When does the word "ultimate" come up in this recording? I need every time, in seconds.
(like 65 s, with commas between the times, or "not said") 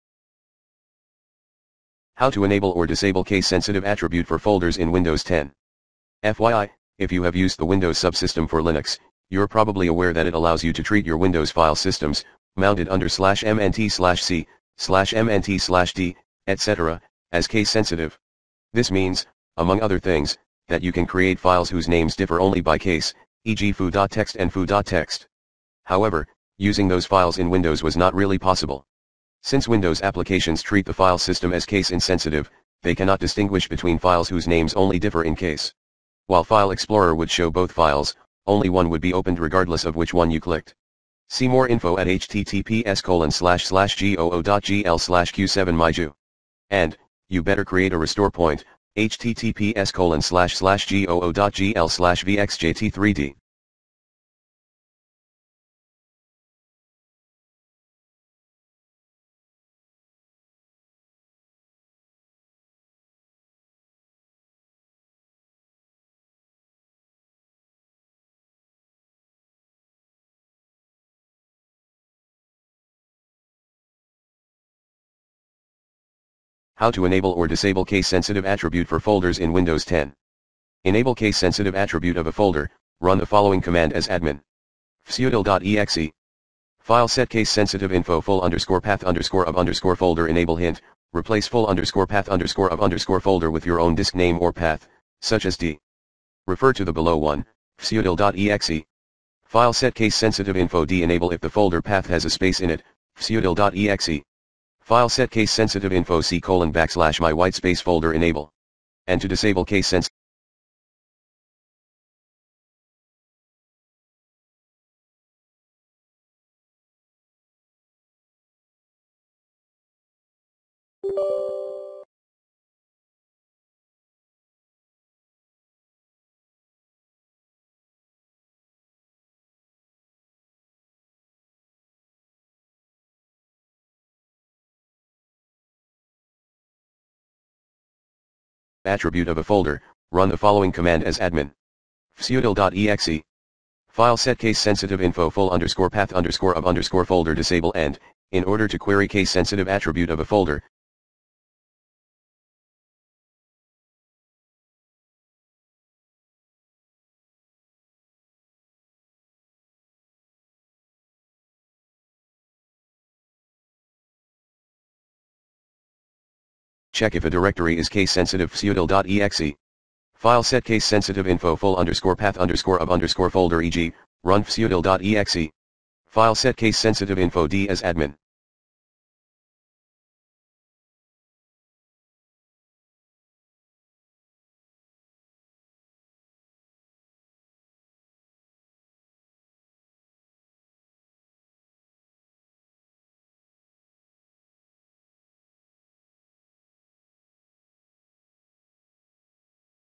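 not said.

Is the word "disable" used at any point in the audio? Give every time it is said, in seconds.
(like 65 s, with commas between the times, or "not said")
2 s, 77 s, 109 s, 147 s.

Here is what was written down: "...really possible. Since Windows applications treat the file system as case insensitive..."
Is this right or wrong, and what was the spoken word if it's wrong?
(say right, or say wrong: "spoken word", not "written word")
right.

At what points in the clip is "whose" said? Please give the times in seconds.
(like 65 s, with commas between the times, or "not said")
21 s, 34 s.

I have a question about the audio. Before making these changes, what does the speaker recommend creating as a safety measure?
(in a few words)
a restore point.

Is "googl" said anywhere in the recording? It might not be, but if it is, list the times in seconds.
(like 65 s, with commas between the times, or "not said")
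43 s, 50 s.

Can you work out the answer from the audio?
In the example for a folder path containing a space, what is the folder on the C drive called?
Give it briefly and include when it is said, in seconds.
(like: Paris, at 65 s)
my whitespace folder, at 107 s.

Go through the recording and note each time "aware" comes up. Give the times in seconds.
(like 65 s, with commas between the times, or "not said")
9 s.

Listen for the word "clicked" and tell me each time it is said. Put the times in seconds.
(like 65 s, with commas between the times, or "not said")
40 s.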